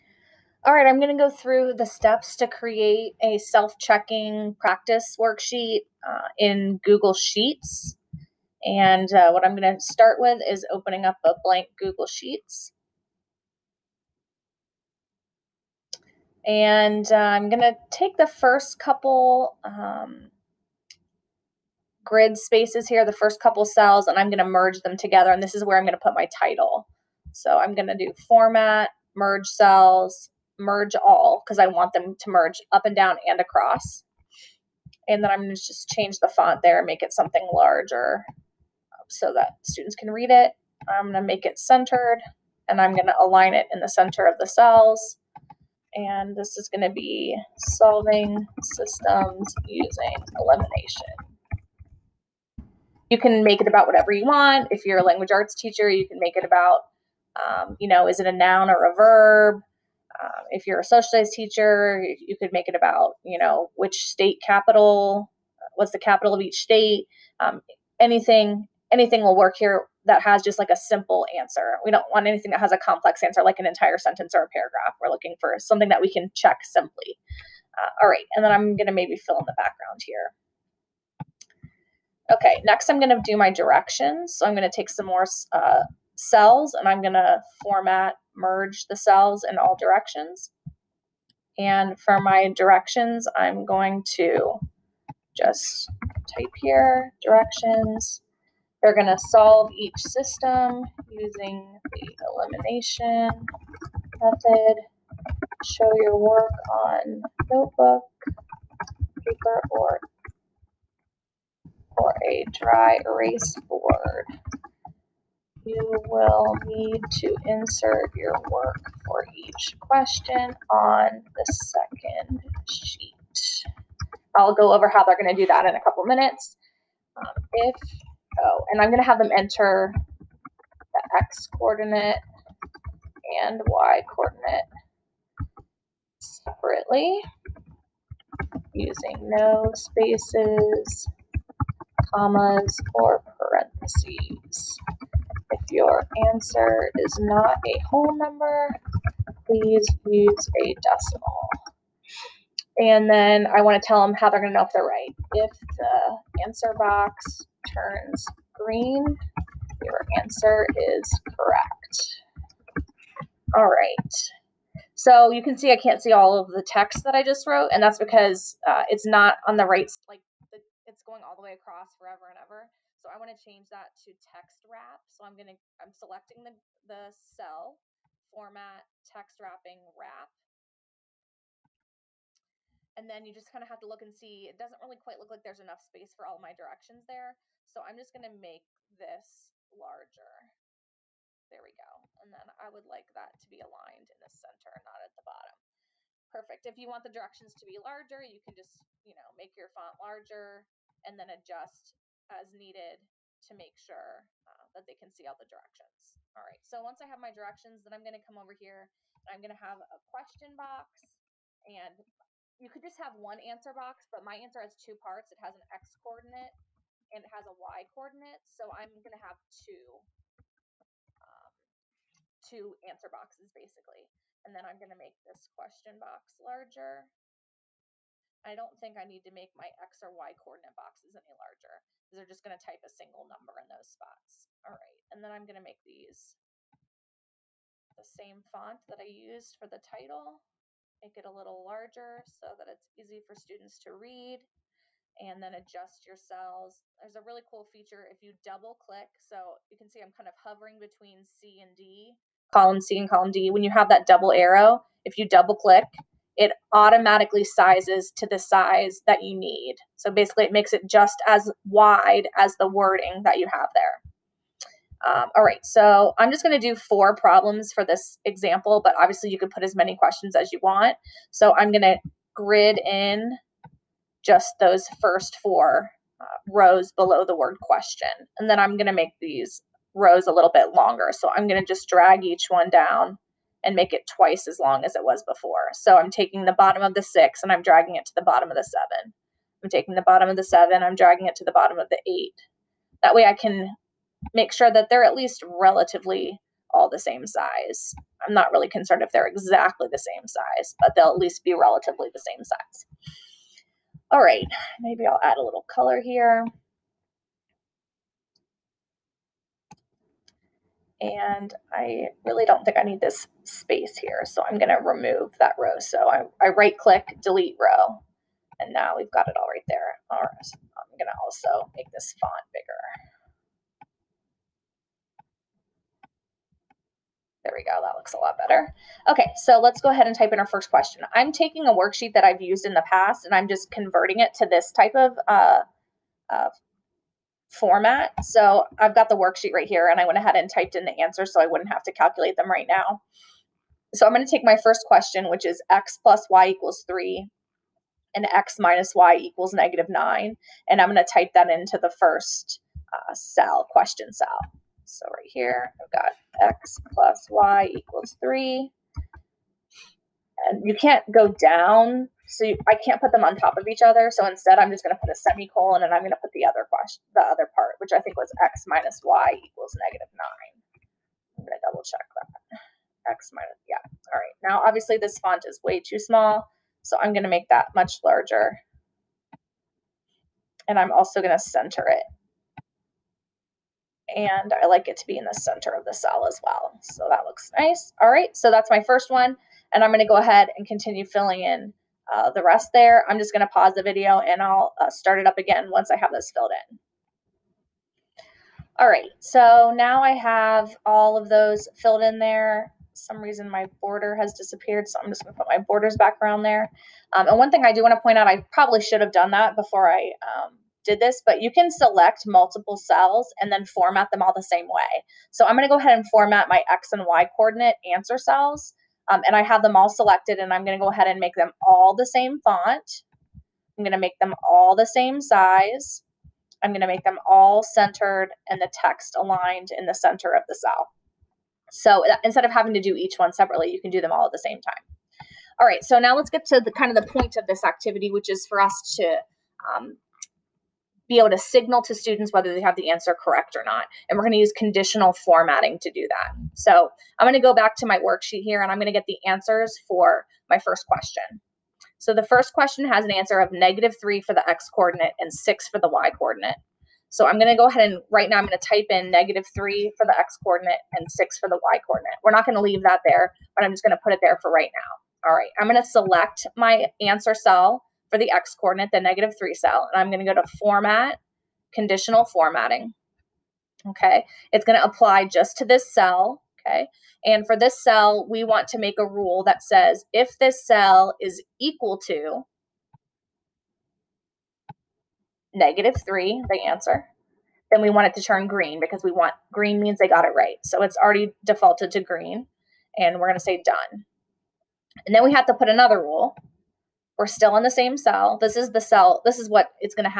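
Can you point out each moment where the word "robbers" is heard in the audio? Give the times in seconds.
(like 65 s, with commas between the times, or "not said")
not said.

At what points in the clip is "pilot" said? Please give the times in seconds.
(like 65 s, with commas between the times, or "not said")
not said.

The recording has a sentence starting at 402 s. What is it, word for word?
some reason my border has disappeared, so I'm just gonna put my borders back around there.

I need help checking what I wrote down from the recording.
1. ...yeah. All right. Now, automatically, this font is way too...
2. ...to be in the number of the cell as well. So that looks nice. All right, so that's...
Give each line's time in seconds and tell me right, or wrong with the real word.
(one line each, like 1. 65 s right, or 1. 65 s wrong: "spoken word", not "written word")
1. 373 s wrong: "obviously", not "automatically"
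2. 384 s wrong: "center", not "number".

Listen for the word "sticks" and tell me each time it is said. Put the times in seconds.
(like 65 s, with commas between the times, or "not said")
not said.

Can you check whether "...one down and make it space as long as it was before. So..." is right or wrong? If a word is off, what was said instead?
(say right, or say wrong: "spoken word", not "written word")
wrong: "twice", not "space".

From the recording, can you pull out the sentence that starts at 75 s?
We're looking for something that we can check simply.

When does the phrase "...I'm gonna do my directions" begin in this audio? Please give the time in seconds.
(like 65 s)
82 s.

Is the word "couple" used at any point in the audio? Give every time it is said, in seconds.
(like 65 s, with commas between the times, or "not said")
18 s, 23 s, 125 s.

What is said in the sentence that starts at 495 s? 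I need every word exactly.
And then we have to put another rule we're still in the same cell.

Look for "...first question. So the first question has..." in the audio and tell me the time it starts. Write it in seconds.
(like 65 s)
450 s.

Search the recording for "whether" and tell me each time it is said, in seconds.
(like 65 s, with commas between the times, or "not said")
442 s.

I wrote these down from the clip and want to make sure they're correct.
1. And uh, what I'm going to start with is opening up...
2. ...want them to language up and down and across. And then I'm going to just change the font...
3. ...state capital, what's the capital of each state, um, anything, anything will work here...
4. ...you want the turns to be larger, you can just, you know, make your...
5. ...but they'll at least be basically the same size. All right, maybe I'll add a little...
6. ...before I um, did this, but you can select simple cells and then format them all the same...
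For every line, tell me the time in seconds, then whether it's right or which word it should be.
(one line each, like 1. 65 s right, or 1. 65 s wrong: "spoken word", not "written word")
1. 8 s right
2. 31 s wrong: "merge", not "language"
3. 64 s right
4. 196 s wrong: "directions", not "turns"
5. 300 s wrong: "relatively", not "basically"
6. 409 s wrong: "multiple", not "simple".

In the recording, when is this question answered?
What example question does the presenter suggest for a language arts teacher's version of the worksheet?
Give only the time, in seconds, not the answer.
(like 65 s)
58 s.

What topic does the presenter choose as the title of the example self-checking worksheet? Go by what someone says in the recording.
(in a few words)
Solving systems using elimination.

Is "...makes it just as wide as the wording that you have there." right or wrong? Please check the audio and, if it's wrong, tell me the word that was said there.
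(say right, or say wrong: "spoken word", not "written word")
right.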